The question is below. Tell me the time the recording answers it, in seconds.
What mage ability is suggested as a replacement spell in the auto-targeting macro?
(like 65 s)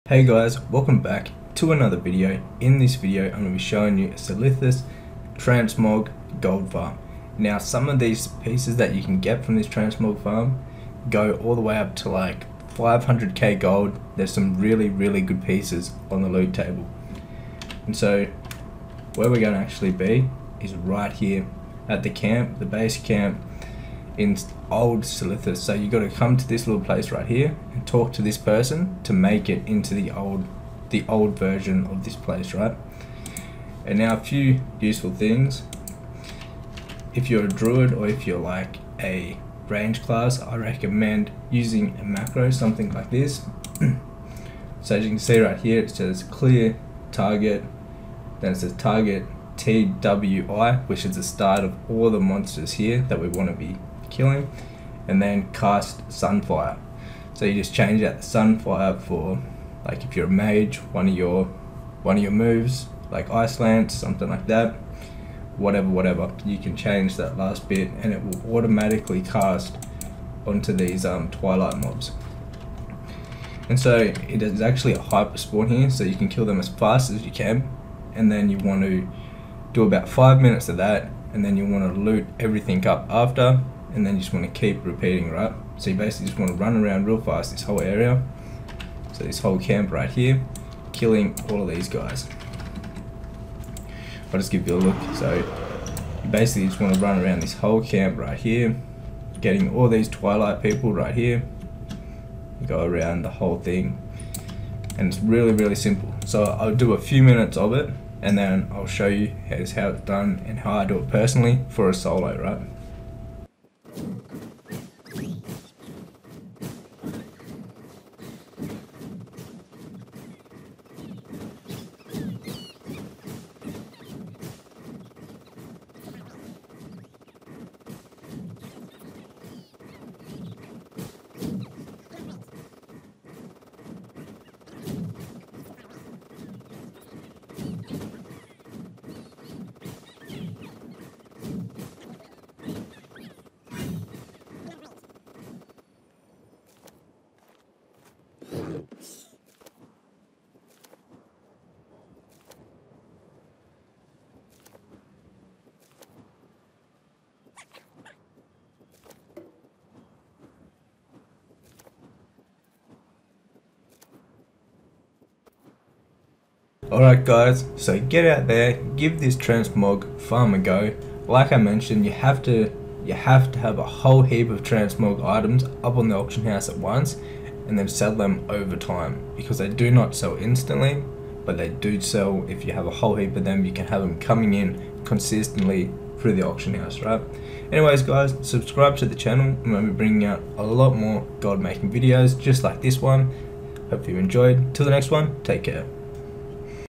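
63 s.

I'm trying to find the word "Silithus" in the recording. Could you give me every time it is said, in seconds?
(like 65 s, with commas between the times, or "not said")
4 s, 25 s.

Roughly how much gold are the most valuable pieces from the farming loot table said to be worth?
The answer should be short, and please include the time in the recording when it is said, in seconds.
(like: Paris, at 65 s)
500k gold, at 12 s.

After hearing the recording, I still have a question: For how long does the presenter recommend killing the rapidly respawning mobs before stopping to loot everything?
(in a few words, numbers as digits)
5 minutes.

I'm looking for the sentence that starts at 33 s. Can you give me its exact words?
And now a few useful things.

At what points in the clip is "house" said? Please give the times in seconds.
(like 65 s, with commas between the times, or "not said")
176 s, 186 s.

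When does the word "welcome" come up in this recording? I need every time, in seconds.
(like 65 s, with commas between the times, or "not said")
0 s.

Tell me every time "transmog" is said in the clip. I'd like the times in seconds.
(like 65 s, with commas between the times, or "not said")
5 s, 9 s, 169 s, 174 s.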